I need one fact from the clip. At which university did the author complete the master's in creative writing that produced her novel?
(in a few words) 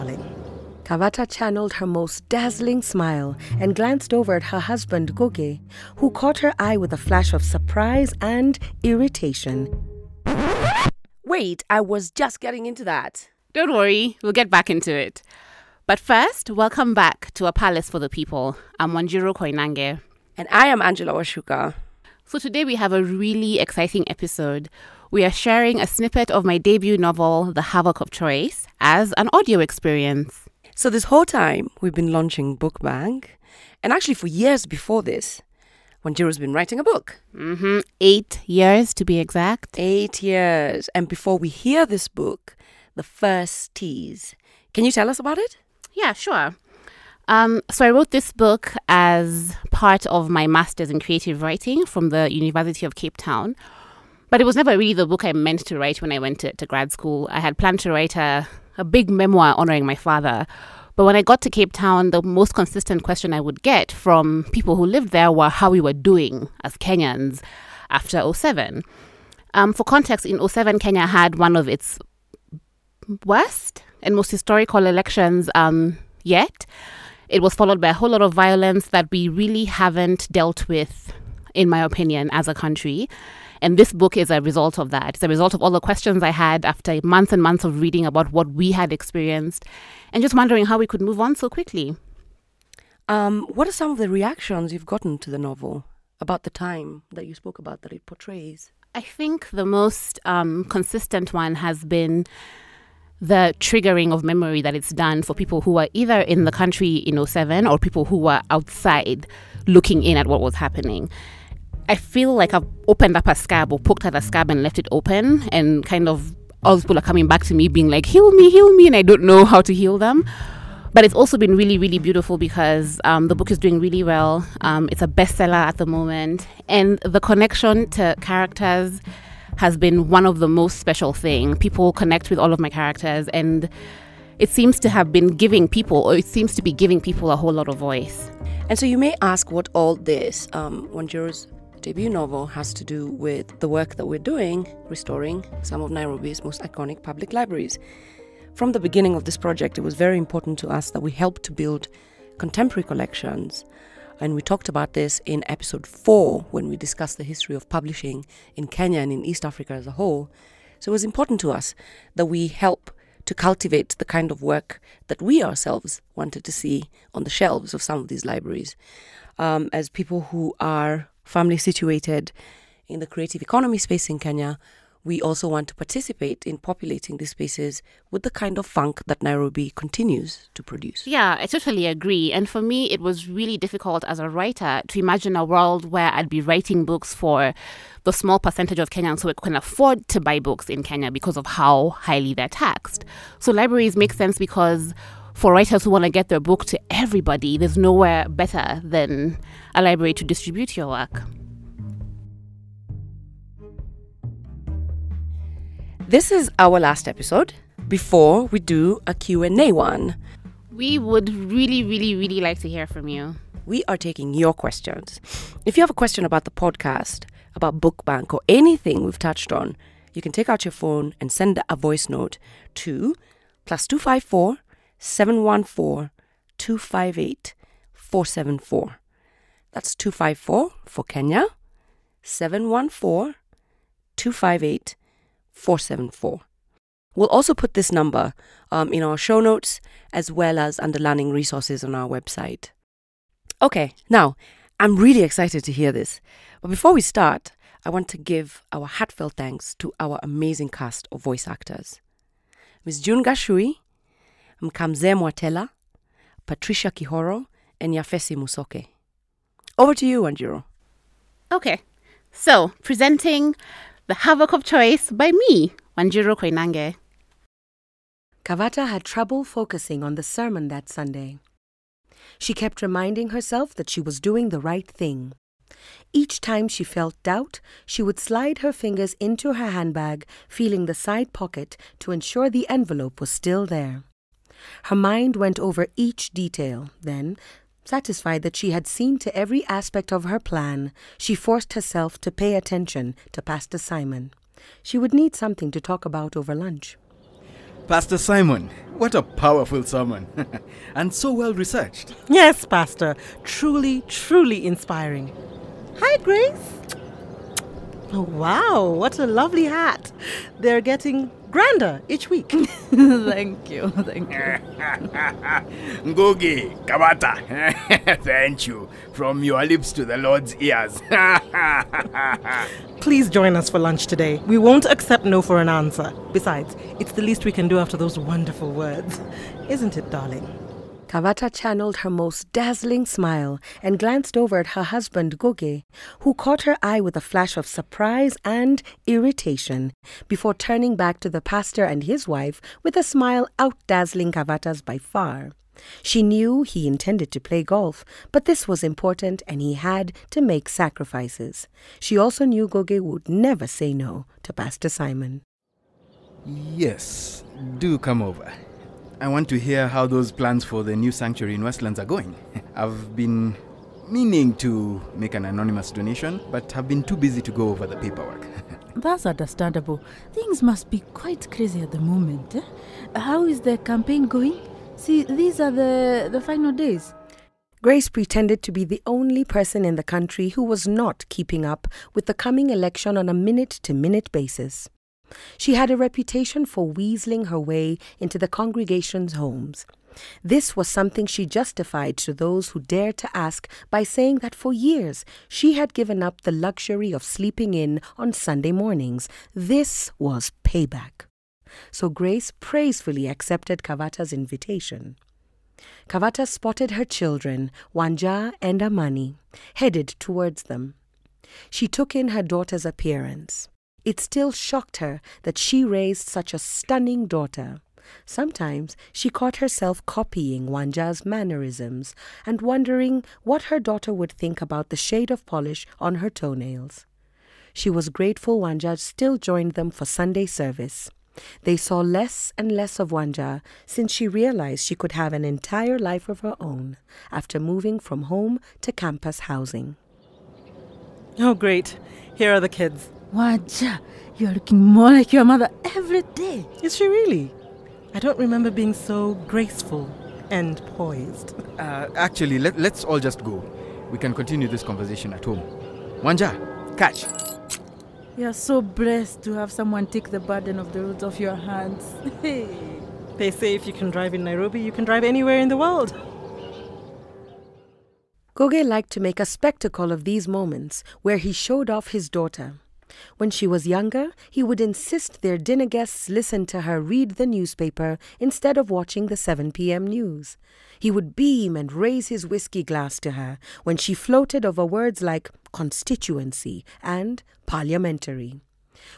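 University of Cape Town.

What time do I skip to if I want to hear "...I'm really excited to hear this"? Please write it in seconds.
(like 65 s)
244 s.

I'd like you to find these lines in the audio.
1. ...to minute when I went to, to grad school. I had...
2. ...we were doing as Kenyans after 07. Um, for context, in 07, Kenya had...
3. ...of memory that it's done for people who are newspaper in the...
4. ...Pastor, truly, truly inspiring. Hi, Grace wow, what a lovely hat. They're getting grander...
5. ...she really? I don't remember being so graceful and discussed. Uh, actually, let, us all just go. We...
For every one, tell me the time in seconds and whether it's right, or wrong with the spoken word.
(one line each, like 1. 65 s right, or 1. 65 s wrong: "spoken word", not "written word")
1. 55 s wrong: "write", not "minute"
2. 65 s right
3. 104 s wrong: "either", not "newspaper"
4. 302 s right
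5. 446 s wrong: "poised", not "discussed".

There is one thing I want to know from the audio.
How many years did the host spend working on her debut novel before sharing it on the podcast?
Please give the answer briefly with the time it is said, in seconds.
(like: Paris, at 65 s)
8, at 37 s.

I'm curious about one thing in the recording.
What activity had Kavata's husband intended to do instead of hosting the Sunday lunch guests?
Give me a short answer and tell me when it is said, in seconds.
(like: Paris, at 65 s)
Golf, at 347 s.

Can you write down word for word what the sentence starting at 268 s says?
Kavata had trouble focusing on the sermon that Sunday.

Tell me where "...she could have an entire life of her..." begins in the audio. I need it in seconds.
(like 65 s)
434 s.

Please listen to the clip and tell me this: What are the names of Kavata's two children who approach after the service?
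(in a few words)
Wanja and Amani.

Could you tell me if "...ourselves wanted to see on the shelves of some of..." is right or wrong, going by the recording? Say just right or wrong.
right.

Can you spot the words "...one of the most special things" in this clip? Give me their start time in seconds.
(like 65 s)
130 s.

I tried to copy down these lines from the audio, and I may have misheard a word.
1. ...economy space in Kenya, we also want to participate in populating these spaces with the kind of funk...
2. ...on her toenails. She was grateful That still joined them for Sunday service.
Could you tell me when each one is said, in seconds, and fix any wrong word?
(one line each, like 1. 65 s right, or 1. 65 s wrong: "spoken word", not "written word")
1. 173 s right
2. 425 s wrong: "Wanja", not "That".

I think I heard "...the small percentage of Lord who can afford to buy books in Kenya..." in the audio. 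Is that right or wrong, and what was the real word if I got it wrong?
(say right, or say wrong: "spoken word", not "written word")
wrong: "Kenyans", not "Lord".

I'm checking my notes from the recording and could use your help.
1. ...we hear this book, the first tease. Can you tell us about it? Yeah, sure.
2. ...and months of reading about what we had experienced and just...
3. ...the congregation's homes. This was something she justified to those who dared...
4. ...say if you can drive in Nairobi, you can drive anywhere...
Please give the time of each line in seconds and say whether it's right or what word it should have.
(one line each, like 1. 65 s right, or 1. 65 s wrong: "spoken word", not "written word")
1. 41 s right
2. 87 s right
3. 388 s right
4. 463 s right.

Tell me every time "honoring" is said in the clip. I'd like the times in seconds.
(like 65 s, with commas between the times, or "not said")
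59 s.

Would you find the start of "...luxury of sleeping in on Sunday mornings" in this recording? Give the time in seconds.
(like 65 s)
396 s.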